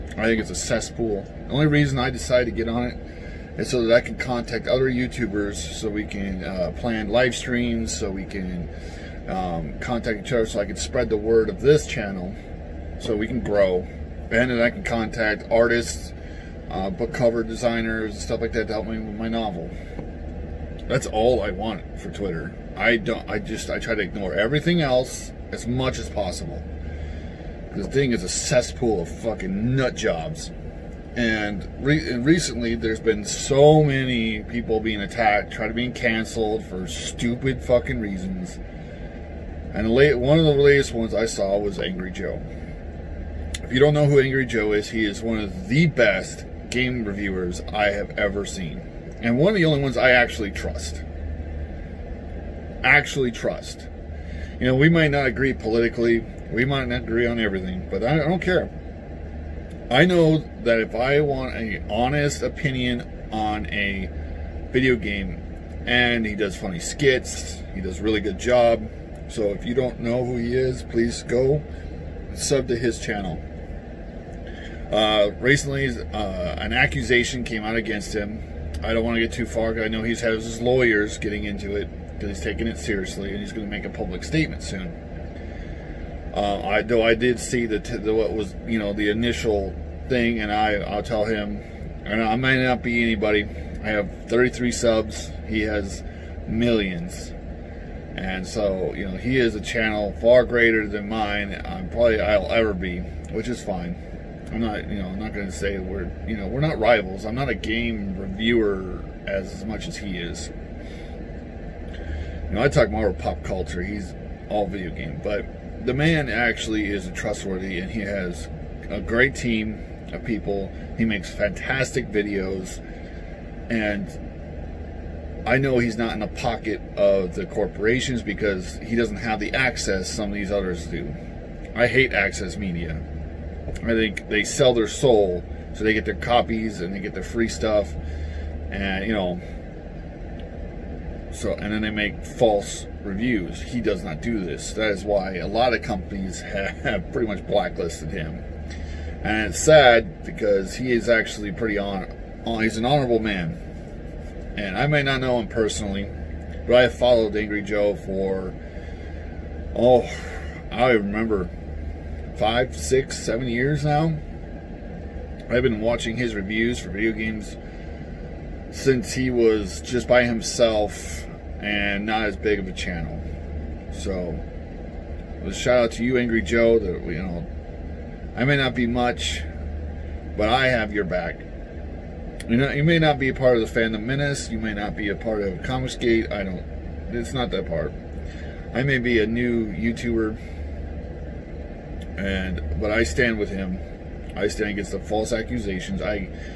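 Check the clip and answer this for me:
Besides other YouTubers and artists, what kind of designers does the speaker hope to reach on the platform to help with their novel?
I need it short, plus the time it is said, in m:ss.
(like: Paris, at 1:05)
Book cover designers, at 0:16.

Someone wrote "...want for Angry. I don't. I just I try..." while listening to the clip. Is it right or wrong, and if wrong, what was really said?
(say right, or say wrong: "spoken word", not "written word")
wrong: "Twitter", not "Angry".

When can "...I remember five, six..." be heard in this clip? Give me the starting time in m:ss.
2:40.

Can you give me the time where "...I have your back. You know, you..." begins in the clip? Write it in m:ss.
3:00.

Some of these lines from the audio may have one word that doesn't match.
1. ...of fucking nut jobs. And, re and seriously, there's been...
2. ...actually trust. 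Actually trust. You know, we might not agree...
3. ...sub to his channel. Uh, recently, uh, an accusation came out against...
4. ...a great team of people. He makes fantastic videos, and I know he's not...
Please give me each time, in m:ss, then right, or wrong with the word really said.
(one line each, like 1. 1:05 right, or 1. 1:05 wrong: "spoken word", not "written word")
1. 0:29 wrong: "recently", not "seriously"
2. 0:50 right
3. 1:12 right
4. 1:58 right.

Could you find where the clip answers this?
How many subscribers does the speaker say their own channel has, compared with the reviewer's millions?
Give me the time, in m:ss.
1:34.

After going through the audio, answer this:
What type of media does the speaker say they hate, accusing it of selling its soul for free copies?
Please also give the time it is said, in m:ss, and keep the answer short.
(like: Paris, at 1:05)
Access media, at 2:12.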